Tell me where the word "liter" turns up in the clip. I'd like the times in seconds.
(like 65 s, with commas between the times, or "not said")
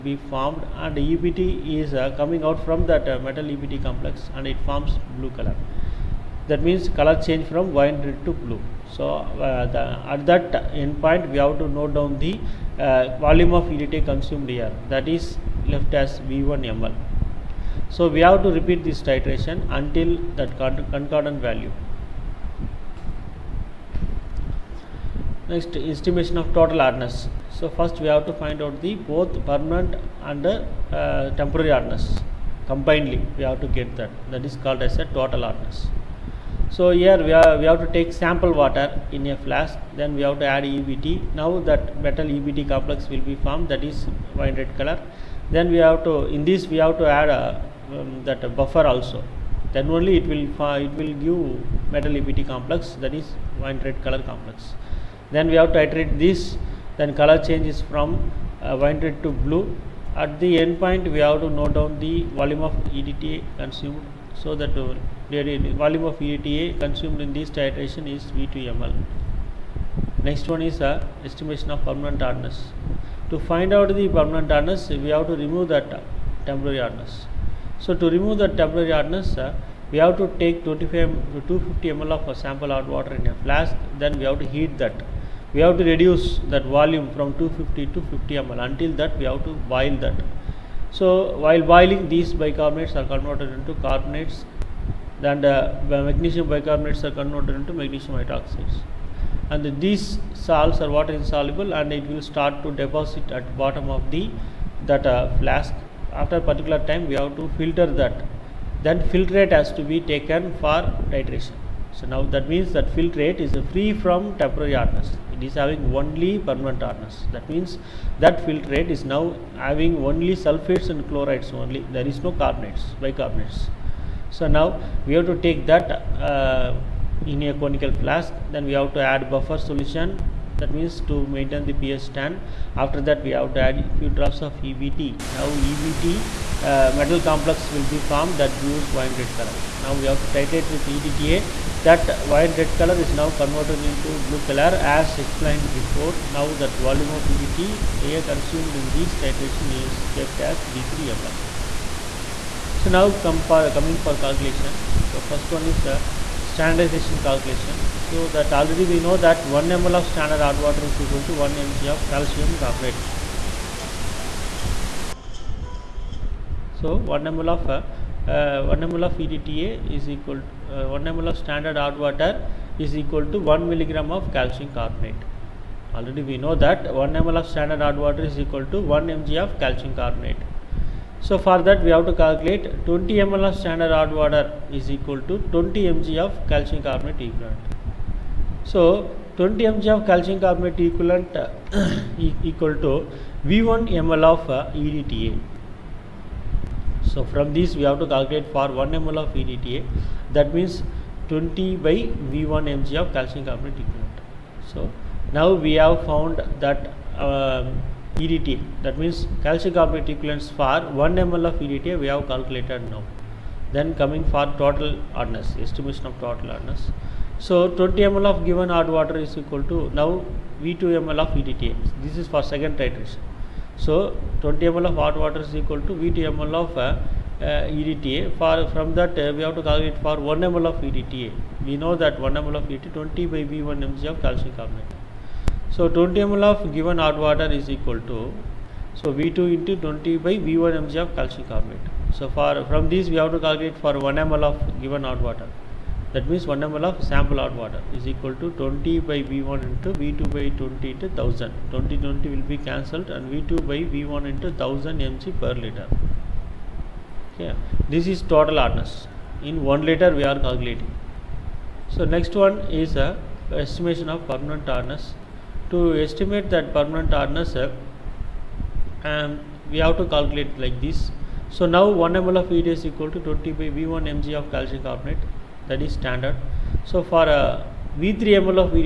255 s, 259 s.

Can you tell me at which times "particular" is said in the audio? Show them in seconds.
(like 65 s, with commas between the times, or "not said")
106 s.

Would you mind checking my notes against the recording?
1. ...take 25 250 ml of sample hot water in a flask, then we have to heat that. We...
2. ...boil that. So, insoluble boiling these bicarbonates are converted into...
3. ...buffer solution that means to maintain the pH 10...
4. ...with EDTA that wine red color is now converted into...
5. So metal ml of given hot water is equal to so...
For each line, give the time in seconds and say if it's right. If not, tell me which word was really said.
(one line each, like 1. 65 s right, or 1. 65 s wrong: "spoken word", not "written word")
1. 80 s right
2. 89 s wrong: "while", not "insoluble"
3. 129 s right
4. 140 s right
5. 235 s wrong: "total", not "metal".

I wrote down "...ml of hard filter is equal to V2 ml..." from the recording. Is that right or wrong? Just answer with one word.
wrong.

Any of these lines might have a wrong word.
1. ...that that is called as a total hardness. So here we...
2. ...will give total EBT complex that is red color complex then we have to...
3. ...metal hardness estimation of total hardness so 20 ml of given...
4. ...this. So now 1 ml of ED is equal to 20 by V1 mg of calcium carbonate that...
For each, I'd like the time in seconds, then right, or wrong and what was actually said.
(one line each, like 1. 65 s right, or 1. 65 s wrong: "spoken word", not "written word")
1. 33 s right
2. 50 s wrong: "metal", not "total"
3. 214 s wrong: "total", not "metal"
4. 270 s right.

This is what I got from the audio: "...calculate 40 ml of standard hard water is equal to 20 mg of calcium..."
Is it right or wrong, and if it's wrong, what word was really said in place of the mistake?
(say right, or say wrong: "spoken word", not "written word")
wrong: "20", not "40".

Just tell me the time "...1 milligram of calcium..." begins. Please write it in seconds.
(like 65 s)
173 s.